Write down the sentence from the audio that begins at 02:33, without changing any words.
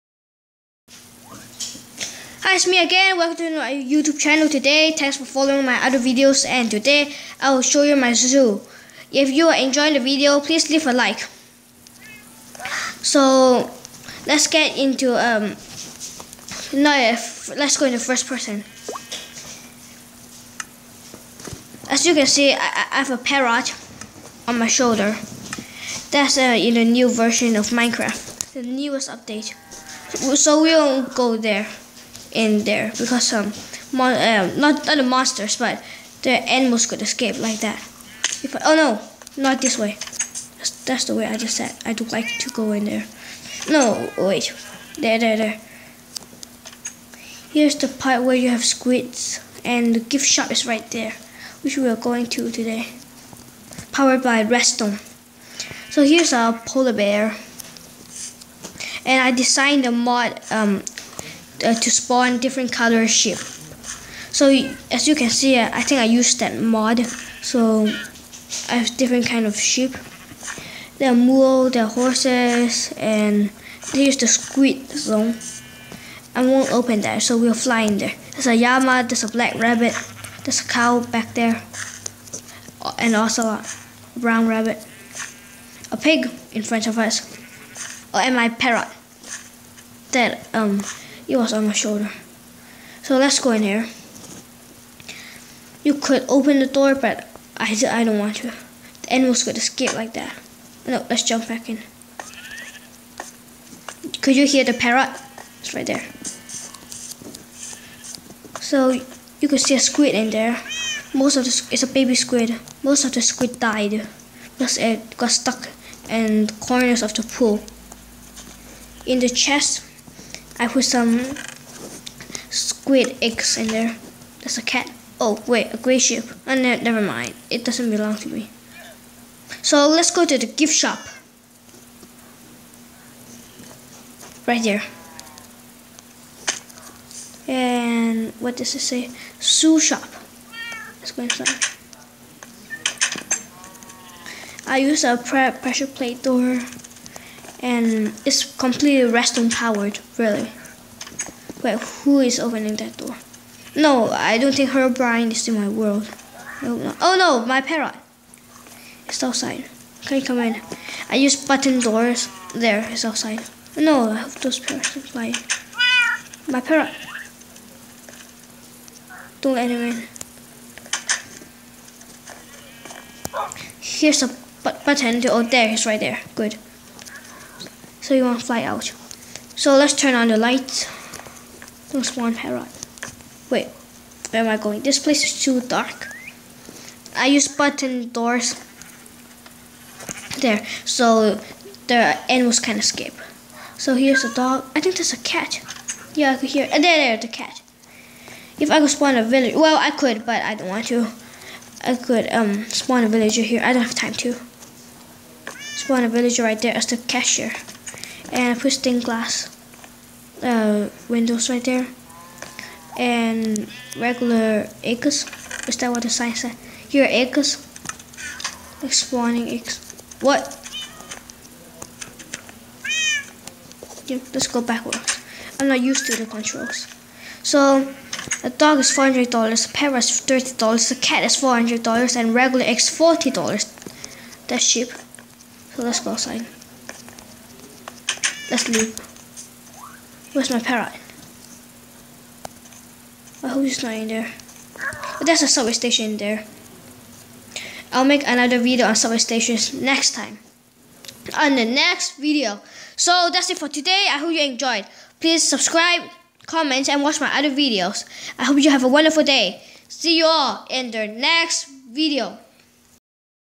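No, I don't think Herobrine is in my world.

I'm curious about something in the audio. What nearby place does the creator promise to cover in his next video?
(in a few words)
subway station.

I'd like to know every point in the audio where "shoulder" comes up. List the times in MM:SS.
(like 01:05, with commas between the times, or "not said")
00:24, 01:31.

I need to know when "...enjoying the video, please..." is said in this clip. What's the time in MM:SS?
00:09.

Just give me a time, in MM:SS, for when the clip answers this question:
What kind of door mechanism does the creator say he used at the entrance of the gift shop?
02:25.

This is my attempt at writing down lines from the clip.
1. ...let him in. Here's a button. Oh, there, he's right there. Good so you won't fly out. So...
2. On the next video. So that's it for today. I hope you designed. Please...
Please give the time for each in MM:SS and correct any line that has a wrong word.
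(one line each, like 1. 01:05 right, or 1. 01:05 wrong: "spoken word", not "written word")
1. 02:49 right
2. 04:11 wrong: "enjoyed", not "designed".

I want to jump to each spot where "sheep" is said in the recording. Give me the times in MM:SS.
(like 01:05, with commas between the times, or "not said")
01:09, 02:05.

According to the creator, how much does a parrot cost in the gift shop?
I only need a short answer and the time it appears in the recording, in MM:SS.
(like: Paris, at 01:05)
$30, at 03:50.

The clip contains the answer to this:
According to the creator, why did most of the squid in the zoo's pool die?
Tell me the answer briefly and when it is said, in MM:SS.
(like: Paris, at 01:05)
stuck in corners, at 01:55.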